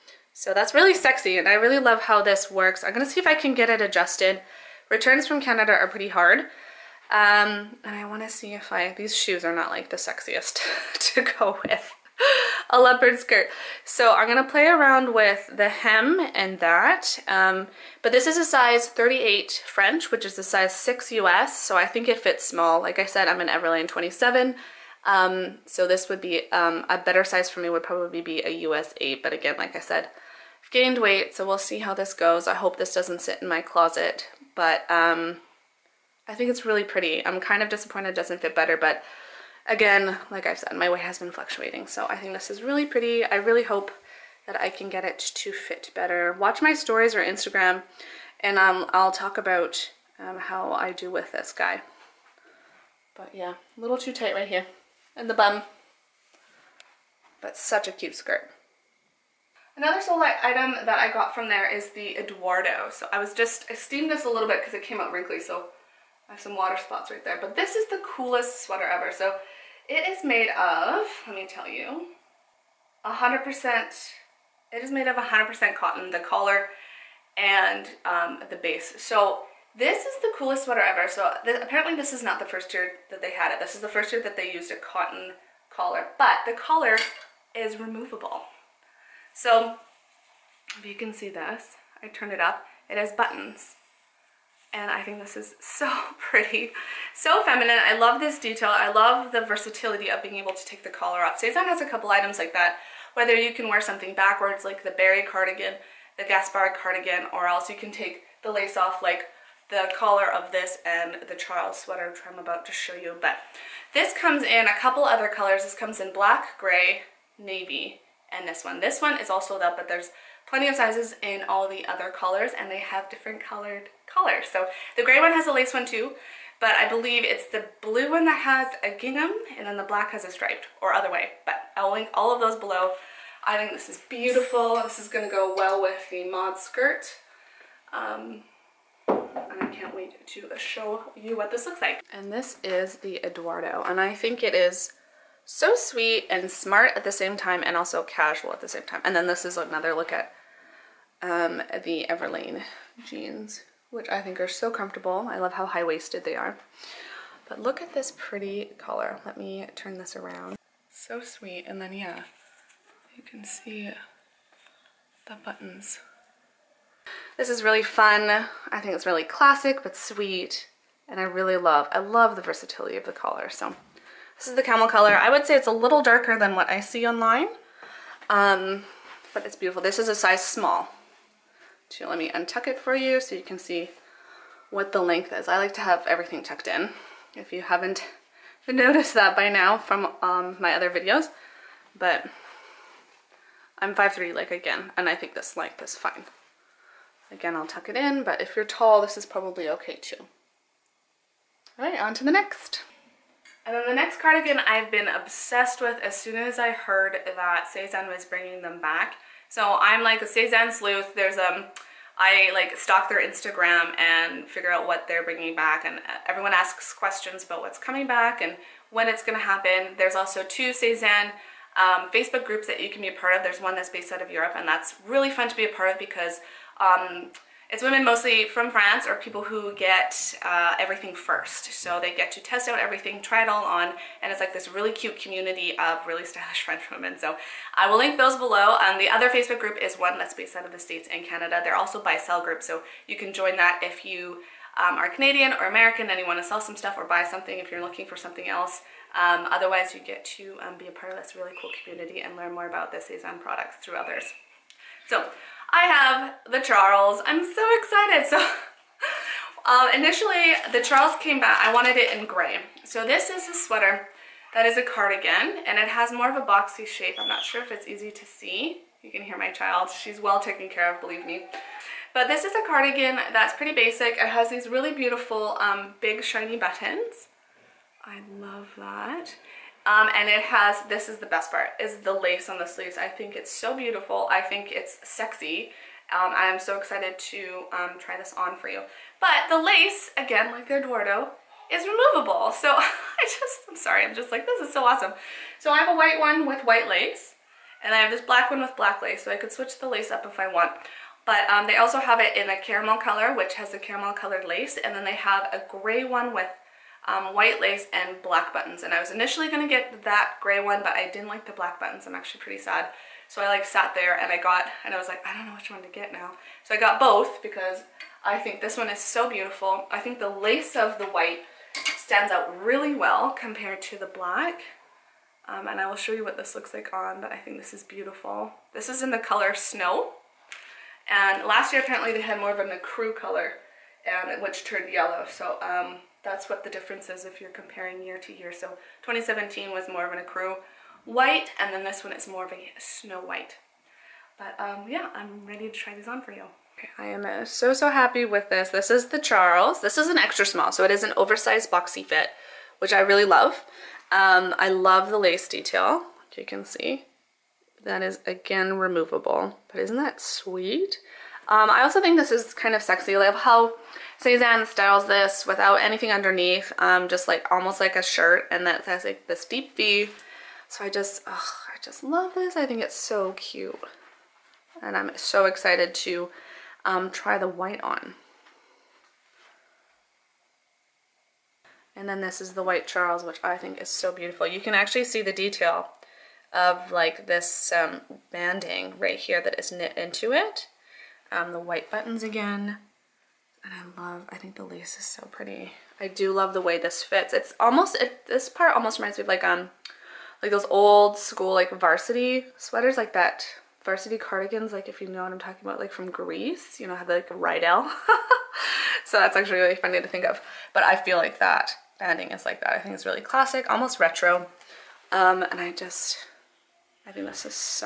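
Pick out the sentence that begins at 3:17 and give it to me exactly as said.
Again, I'll tuck it in, but if you're tall, this is probably okay too.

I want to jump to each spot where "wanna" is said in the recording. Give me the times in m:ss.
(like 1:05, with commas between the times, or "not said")
0:08.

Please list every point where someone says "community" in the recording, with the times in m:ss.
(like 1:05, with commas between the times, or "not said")
3:55, 4:11.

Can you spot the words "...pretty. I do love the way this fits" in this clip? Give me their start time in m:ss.
6:35.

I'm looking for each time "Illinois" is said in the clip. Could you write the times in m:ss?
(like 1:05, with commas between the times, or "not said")
not said.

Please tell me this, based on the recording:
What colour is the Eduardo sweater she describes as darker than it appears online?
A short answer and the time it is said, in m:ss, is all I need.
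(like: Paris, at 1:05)
camel, at 2:54.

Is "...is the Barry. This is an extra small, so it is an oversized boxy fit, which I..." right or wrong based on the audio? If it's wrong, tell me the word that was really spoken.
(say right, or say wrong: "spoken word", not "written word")
wrong: "Charles", not "Barry".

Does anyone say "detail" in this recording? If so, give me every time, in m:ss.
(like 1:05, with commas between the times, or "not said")
1:38, 5:55, 6:25.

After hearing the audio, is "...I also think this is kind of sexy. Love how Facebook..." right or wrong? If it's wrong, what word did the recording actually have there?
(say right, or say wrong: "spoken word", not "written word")
wrong: "Sézane", not "Facebook".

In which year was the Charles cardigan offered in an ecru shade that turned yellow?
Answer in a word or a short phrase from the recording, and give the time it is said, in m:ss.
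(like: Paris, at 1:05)
2017, at 5:39.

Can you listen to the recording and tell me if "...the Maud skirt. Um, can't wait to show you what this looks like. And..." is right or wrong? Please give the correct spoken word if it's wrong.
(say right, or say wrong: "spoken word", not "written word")
right.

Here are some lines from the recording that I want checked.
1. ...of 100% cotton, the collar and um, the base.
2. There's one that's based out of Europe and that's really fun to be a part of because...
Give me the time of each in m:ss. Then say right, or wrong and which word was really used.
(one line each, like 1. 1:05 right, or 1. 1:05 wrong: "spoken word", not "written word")
1. 1:15 right
2. 3:43 right.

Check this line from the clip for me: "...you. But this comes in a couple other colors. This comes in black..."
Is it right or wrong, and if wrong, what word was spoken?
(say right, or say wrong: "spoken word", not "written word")
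right.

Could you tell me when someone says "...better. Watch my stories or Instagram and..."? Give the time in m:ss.
0:45.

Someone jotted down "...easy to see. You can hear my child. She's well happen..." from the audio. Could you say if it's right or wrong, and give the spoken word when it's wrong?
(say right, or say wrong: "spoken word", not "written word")
wrong: "taken", not "happen".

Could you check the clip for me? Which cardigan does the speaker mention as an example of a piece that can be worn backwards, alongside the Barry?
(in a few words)
Gaspard.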